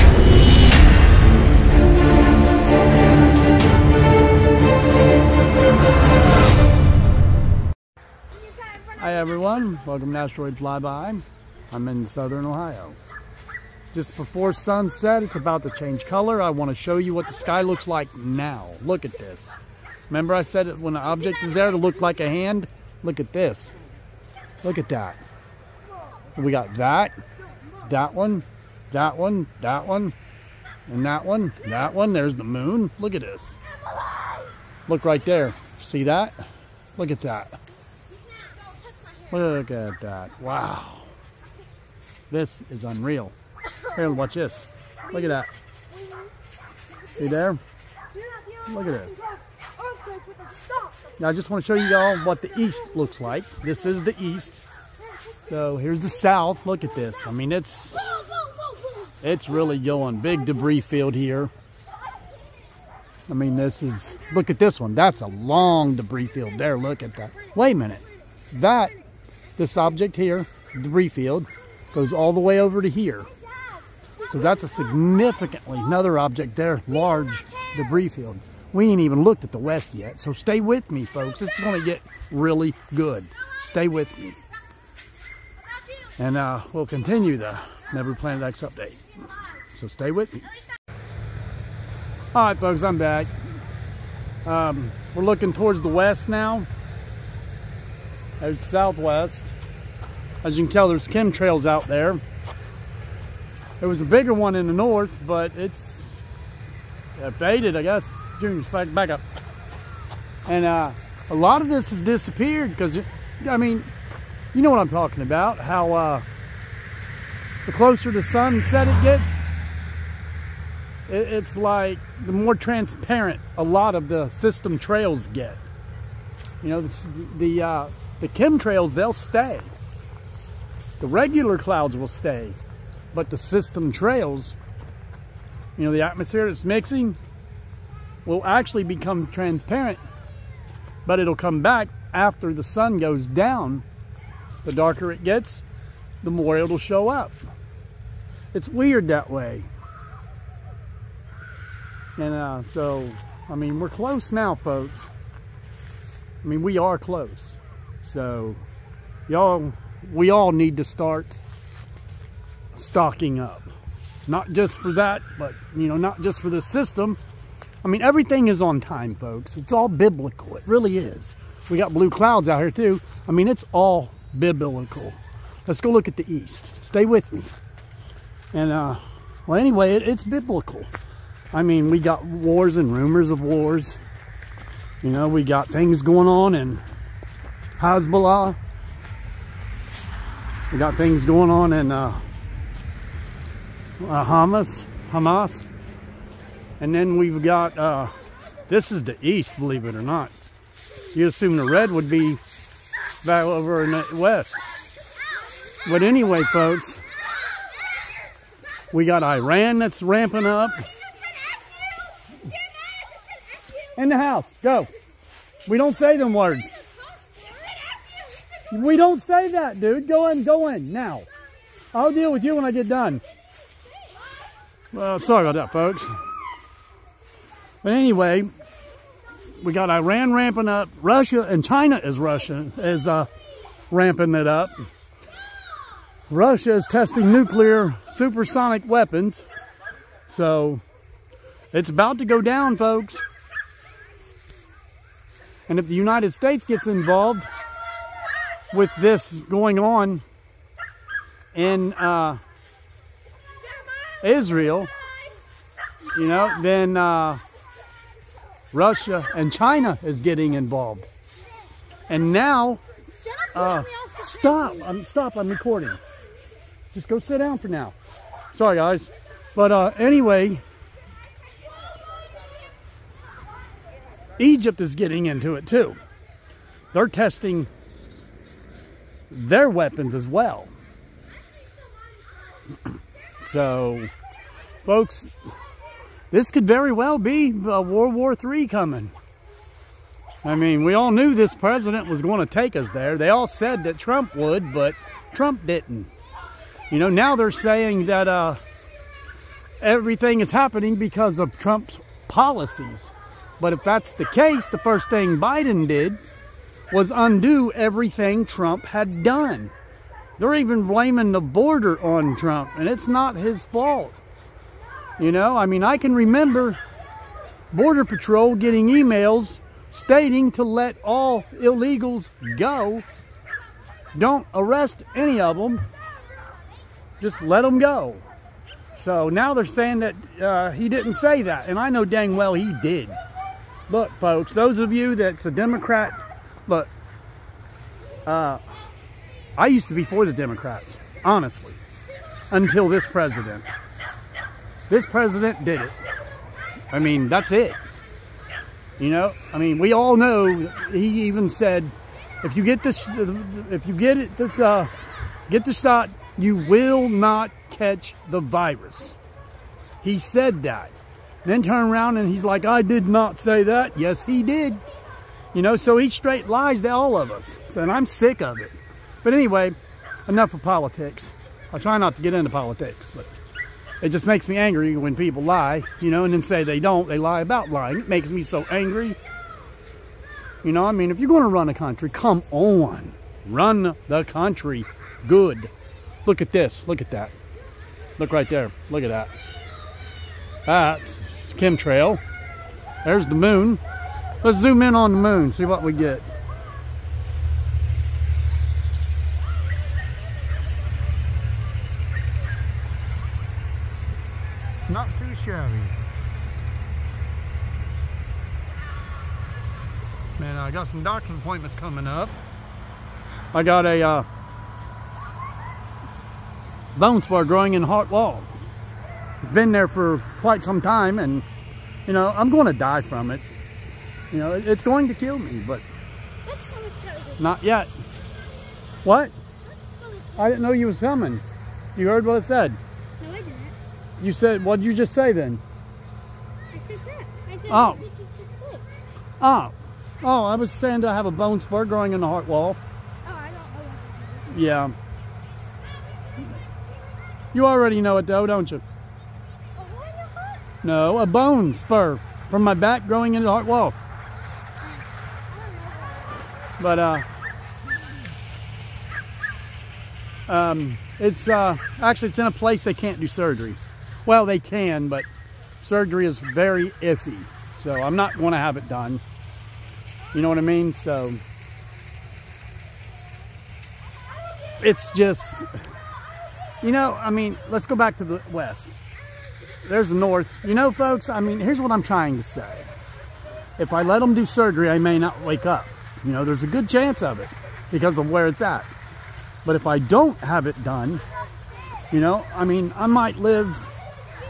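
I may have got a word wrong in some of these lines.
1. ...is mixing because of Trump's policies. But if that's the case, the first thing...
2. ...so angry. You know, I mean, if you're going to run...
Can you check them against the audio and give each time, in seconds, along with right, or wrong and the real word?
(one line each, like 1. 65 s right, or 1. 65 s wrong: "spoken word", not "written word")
1. 300 s wrong: "happening", not "mixing"
2. 378 s right.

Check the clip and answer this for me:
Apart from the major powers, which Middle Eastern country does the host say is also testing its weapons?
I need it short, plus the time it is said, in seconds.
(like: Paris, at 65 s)
Egypt, at 274 s.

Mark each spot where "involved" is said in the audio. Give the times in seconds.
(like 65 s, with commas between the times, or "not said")
246 s, 260 s.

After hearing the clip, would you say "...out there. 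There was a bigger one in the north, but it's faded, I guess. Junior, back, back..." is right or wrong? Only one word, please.
right.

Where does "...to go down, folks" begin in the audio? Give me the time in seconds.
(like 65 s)
242 s.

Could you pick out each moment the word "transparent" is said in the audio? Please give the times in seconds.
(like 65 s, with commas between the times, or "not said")
122 s, 139 s.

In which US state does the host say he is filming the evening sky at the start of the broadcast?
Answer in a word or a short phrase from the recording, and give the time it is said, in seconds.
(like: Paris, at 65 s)
Ohio, at 12 s.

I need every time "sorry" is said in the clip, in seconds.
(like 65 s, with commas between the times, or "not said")
225 s, 268 s.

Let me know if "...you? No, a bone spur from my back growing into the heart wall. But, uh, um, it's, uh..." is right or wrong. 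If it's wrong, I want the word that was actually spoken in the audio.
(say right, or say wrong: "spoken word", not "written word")
right.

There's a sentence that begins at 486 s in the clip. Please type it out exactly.
You know, there's a good chance of it because of where it's at.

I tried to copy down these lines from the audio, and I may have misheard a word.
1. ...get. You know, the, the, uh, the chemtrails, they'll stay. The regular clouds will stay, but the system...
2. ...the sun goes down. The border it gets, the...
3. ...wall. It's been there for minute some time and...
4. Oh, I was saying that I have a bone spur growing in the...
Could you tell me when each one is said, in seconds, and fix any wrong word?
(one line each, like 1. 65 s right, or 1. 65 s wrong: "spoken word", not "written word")
1. 125 s right
2. 142 s wrong: "darker", not "border"
3. 418 s wrong: "quite", not "minute"
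4. 440 s right.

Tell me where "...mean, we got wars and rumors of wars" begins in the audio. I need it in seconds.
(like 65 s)
181 s.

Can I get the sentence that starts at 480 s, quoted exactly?
You know, folks, I mean, here's what I'm trying to say.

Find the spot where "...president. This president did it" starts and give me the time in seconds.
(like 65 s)
343 s.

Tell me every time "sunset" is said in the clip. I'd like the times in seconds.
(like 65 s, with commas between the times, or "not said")
14 s, 118 s.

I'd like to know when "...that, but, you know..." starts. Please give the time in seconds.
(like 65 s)
164 s.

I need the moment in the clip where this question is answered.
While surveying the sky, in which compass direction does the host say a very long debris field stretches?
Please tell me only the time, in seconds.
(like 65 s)
55 s.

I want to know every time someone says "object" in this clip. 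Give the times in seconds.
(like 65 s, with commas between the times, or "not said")
21 s, 69 s, 76 s.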